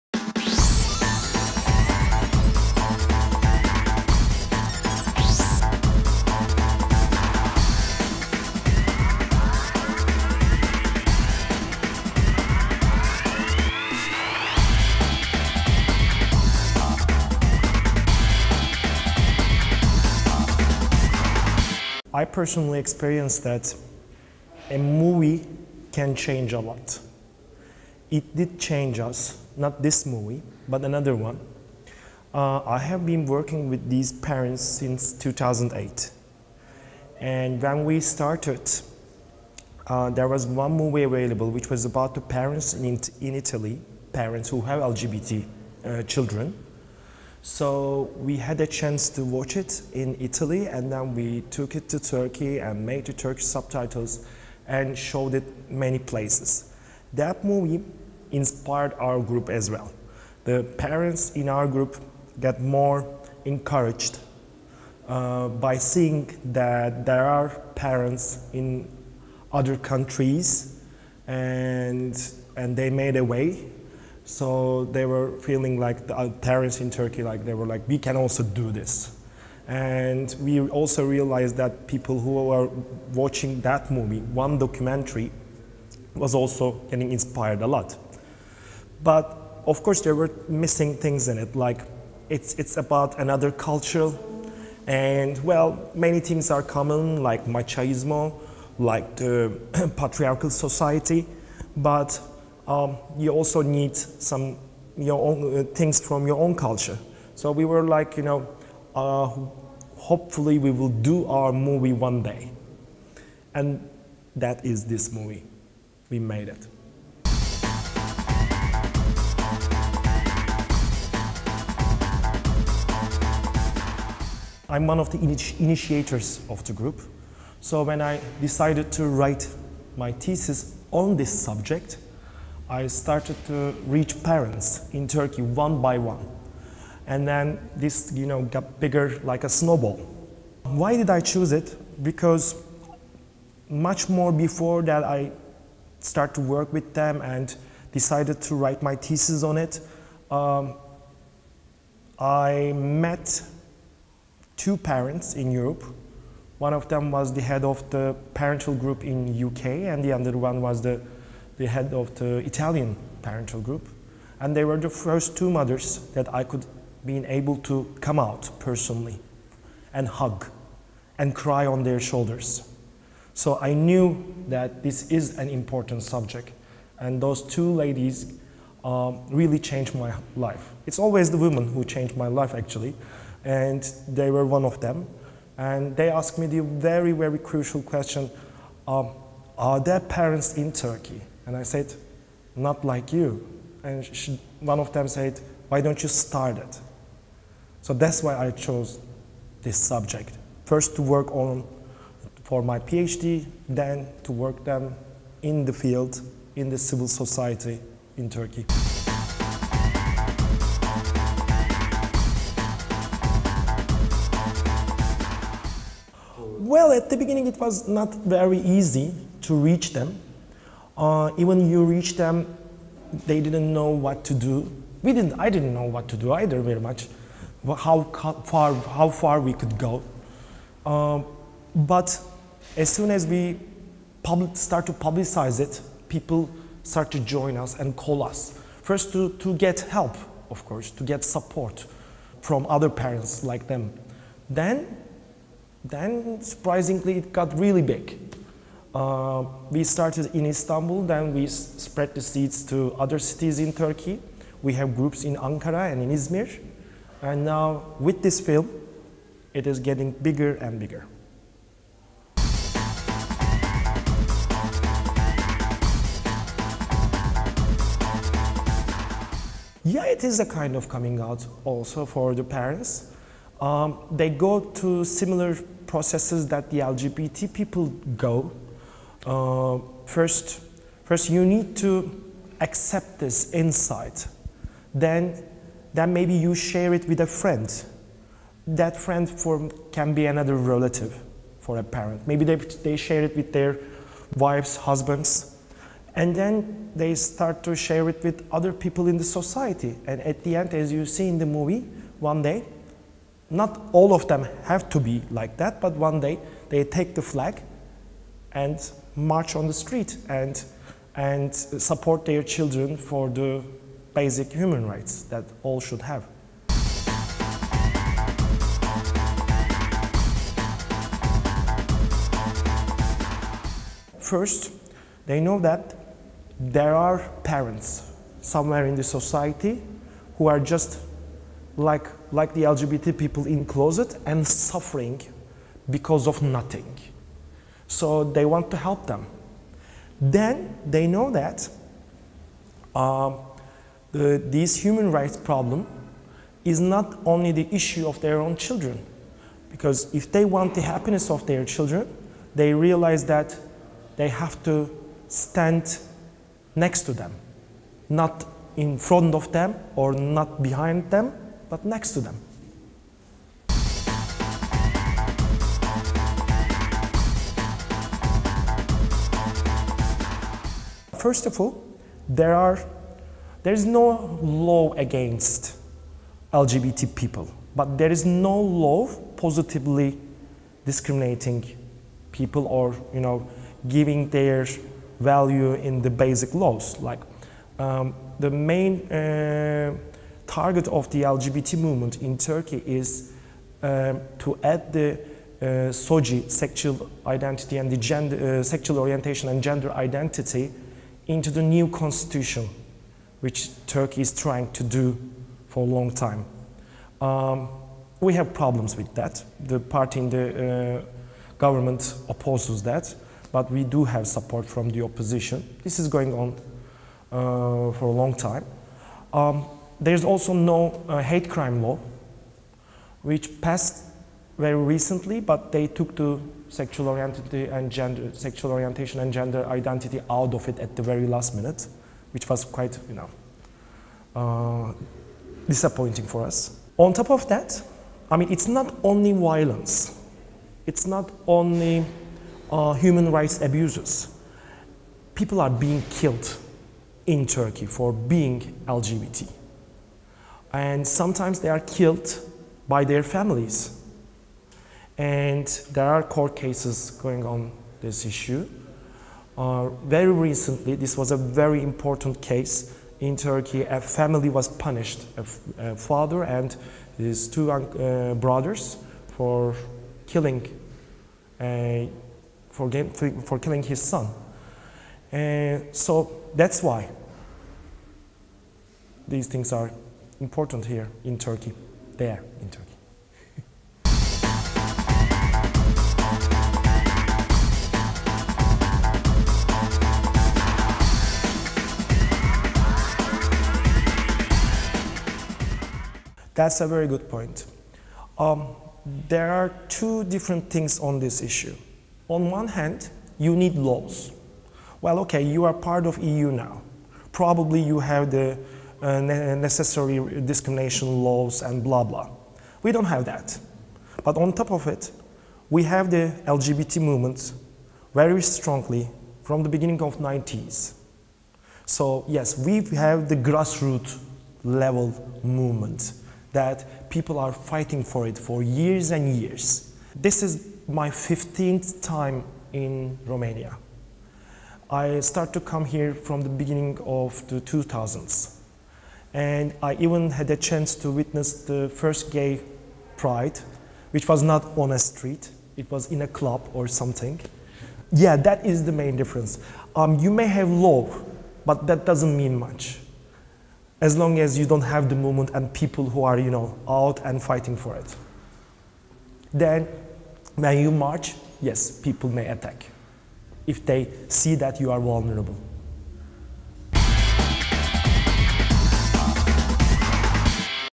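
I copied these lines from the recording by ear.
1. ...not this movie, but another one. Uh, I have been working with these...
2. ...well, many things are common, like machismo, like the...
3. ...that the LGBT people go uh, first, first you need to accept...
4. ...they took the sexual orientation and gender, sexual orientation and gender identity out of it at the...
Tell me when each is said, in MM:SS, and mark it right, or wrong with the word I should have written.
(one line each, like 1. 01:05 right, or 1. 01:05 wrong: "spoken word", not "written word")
1. 00:29 right
2. 01:35 right
3. 04:36 right
4. 07:05 right.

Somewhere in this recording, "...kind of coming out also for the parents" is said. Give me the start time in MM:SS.
04:30.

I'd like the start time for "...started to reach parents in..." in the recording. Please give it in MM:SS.
02:12.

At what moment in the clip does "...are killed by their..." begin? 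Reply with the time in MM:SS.
07:31.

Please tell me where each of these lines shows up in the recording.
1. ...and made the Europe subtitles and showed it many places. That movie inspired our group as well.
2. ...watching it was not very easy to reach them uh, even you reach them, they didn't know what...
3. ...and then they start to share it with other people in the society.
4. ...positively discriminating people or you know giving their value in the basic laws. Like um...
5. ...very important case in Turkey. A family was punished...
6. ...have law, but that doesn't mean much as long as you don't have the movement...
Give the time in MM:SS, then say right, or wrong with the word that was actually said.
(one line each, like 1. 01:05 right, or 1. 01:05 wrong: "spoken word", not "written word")
1. 00:52 wrong: "Turkish", not "Europe"
2. 03:37 wrong: "beginning", not "watching"
3. 04:56 right
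4. 06:19 right
5. 07:41 right
6. 09:10 right.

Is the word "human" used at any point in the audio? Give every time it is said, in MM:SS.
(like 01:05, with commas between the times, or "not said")
05:14, 05:44, 07:22.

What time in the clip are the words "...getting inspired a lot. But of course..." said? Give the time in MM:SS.
01:26.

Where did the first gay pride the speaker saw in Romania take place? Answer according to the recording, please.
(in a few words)
a club.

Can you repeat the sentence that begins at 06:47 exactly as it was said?
Um, we have problems with that.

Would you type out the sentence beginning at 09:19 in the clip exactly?
Then, when you march, yes, people may attack if they see that you are vulnerable.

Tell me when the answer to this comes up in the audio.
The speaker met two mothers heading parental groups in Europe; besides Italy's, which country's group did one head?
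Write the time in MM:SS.
02:39.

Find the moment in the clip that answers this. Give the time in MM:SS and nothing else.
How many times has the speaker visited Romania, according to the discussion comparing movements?
08:51.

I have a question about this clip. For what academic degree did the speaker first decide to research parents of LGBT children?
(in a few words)
PhD.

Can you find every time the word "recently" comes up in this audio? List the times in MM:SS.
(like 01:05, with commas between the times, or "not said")
07:04, 07:40.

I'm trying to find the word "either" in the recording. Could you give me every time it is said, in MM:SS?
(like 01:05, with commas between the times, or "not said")
03:46.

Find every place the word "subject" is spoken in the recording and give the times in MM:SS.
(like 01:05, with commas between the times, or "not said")
02:11, 02:56, 03:19.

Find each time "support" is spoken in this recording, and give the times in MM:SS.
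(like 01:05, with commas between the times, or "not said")
04:01, 05:11, 06:54.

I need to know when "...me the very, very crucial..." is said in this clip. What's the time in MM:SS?
03:06.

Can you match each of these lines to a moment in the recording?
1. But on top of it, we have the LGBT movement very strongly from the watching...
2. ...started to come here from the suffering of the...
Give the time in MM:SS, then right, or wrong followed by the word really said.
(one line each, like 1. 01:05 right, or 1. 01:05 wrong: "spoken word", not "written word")
1. 08:34 wrong: "beginning", not "watching"
2. 08:55 wrong: "beginning", not "suffering".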